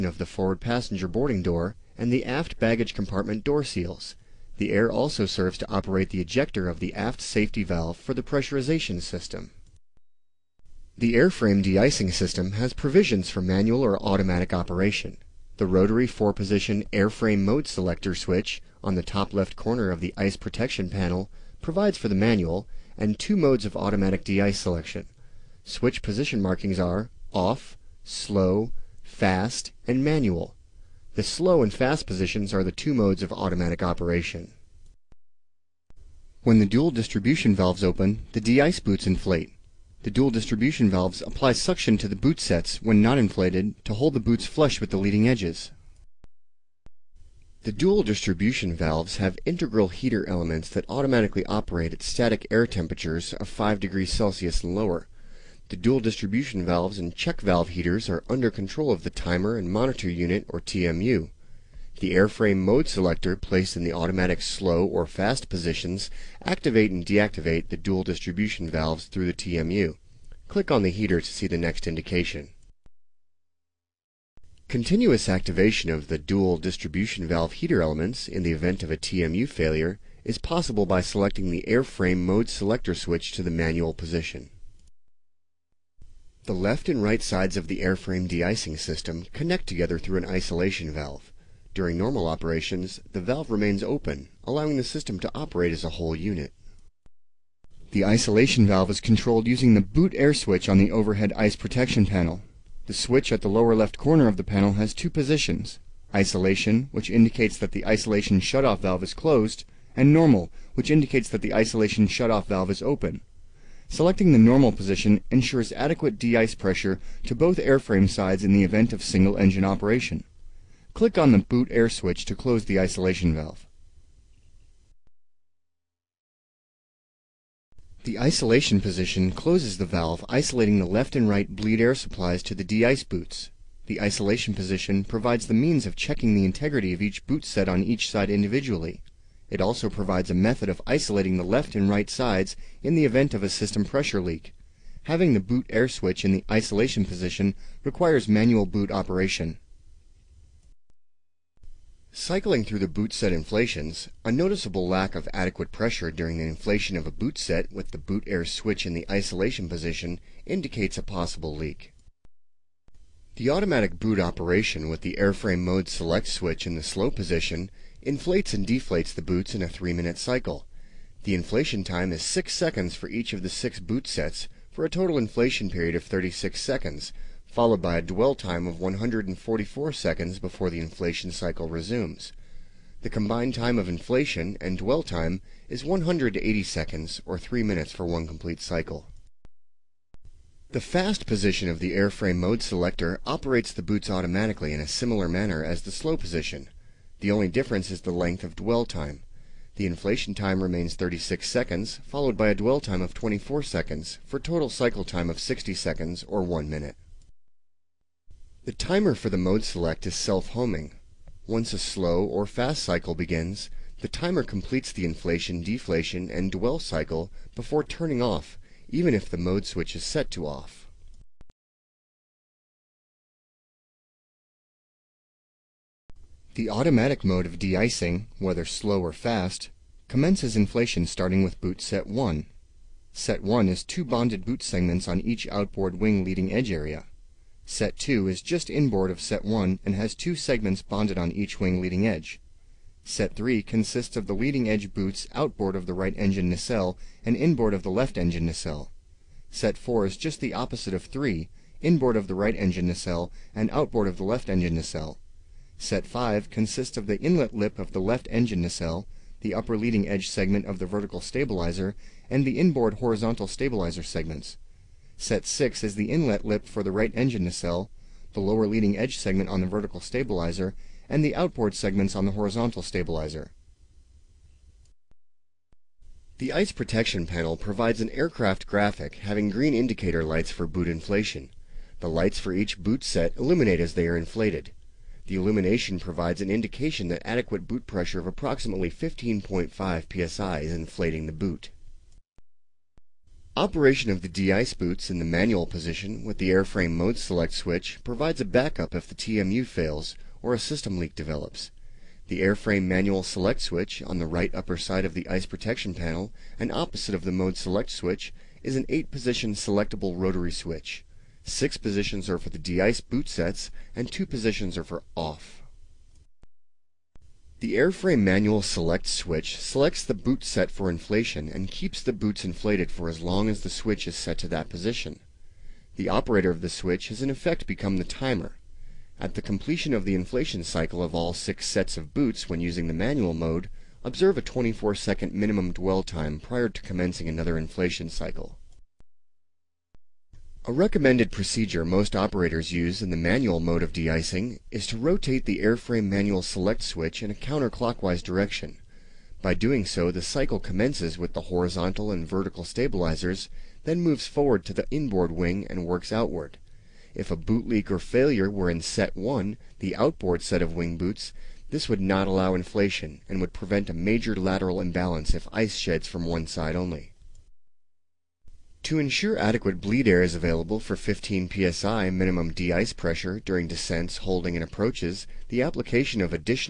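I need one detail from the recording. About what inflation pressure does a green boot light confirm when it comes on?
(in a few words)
15.5 psi.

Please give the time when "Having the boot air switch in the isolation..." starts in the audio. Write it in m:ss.
2:25.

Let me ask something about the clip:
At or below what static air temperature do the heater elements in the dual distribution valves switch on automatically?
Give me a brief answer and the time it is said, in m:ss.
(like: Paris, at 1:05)
5 degrees Celsius, at 0:53.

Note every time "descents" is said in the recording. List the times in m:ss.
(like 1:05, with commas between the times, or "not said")
6:13.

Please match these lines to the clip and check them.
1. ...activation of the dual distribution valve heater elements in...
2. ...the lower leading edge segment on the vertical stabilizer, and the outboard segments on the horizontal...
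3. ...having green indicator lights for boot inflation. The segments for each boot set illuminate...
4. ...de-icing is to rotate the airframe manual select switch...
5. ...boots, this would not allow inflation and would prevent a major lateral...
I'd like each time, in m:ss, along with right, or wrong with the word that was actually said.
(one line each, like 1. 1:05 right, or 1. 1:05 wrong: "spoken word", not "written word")
1. 1:15 right
2. 4:28 right
3. 4:39 wrong: "lights", not "segments"
4. 5:43 right
5. 6:00 right.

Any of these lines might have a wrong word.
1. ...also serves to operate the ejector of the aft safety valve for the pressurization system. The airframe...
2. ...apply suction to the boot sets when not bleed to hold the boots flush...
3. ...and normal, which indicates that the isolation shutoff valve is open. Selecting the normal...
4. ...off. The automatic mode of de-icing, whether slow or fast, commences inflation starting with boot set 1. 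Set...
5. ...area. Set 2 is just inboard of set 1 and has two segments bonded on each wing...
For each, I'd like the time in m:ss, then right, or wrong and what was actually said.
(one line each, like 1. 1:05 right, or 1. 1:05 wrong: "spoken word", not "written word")
1. 0:04 right
2. 0:41 wrong: "inflated", not "bleed"
3. 1:49 right
4. 3:40 right
5. 3:56 right.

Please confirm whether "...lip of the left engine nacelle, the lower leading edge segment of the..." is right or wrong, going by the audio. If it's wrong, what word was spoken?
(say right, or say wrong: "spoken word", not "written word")
wrong: "upper", not "lower".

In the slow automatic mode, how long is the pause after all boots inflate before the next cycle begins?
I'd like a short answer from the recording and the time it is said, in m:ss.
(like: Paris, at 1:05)
144 seconds, at 2:58.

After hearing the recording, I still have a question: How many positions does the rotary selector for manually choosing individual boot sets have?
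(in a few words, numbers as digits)
8.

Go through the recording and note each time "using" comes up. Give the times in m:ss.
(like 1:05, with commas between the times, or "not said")
1:39, 5:32.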